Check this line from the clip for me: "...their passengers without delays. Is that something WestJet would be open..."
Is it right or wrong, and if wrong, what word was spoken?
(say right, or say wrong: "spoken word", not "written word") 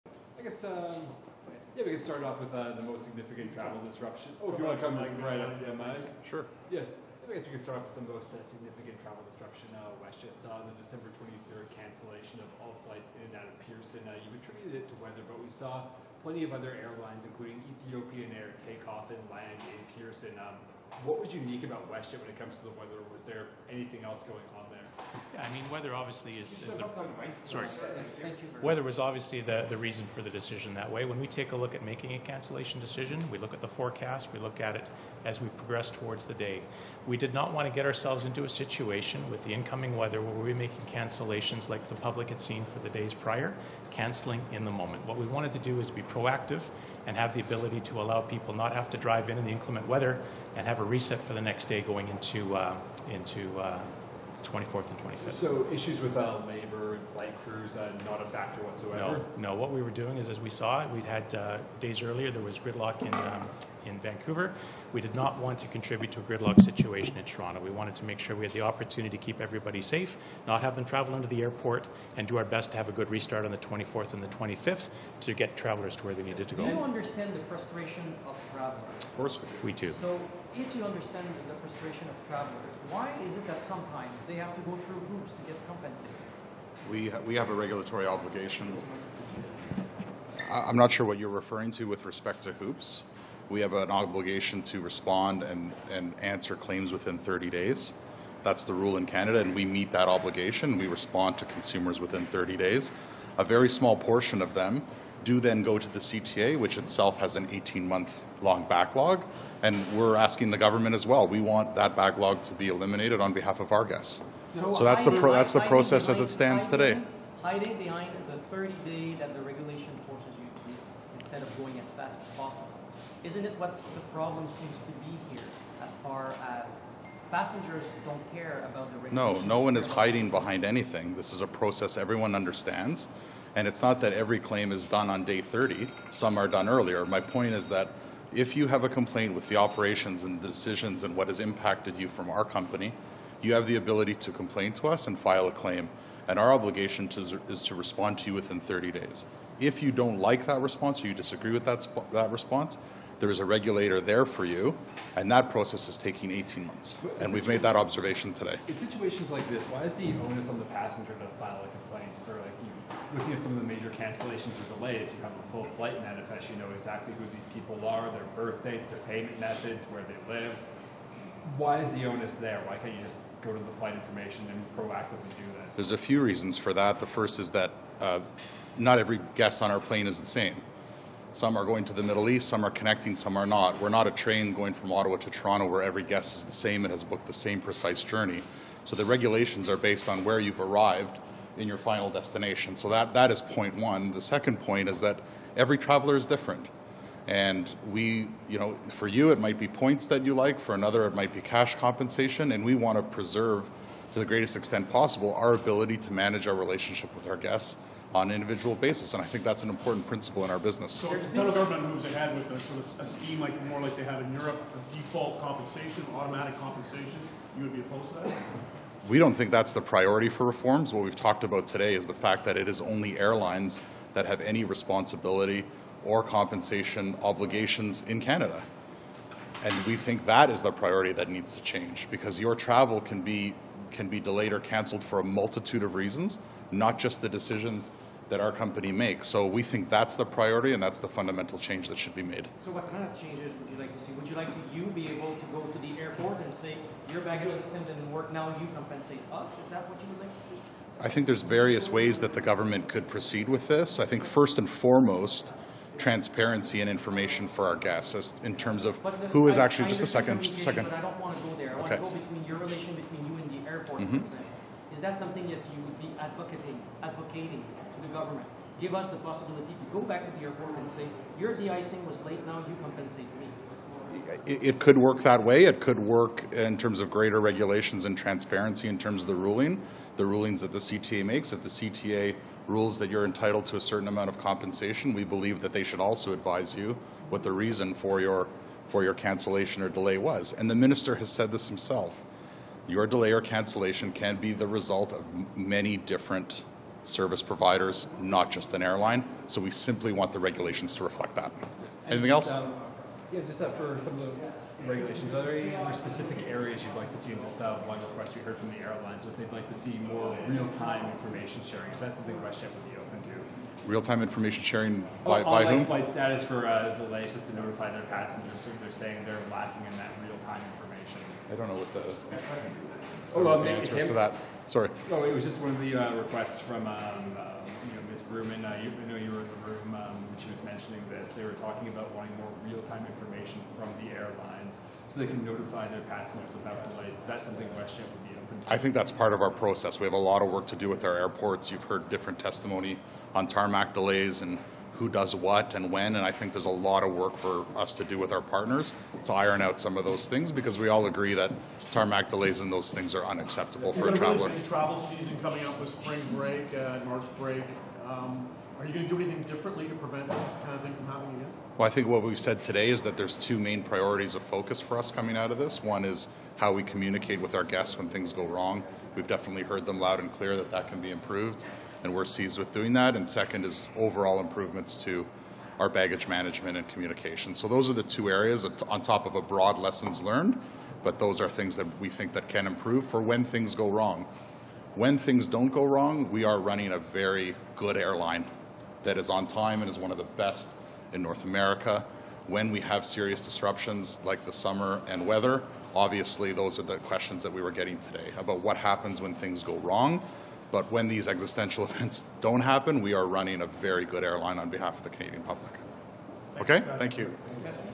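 right.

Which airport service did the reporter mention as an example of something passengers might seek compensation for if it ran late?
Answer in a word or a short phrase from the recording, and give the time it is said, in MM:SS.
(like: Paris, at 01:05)
De-icing, at 04:31.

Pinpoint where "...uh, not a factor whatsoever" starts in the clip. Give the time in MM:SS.
00:57.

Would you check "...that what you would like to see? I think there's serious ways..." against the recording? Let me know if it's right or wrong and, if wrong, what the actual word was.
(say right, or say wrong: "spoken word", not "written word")
wrong: "various", not "serious".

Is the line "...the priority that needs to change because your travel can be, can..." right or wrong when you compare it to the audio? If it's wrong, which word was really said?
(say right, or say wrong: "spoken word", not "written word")
right.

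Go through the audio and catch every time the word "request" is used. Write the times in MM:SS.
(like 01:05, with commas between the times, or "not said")
05:08, 05:26.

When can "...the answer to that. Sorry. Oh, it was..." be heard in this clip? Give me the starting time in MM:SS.
05:23.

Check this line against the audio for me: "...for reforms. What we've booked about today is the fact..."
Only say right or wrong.
wrong.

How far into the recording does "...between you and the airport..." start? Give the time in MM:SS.
04:22.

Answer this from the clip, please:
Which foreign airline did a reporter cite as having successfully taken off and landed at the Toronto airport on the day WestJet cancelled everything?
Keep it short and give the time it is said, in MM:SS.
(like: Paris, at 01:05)
Ethiopian Air, at 00:17.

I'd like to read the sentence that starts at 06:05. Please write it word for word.
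One is how we communicate with our guests when things go wrong.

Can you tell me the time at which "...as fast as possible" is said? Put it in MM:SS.
02:01.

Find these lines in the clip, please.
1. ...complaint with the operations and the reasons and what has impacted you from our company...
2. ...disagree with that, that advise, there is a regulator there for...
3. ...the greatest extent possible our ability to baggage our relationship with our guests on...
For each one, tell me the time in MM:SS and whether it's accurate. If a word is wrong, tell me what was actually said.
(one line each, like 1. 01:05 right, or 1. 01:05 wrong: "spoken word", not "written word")
1. 02:18 wrong: "decisions", not "reasons"
2. 02:31 wrong: "response", not "advise"
3. 03:24 wrong: "manage", not "baggage".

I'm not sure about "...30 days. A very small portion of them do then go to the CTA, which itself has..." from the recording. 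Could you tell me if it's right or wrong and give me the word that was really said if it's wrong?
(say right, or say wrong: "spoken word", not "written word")
right.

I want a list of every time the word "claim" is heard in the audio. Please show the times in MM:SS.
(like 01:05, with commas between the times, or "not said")
01:36, 02:14, 02:25.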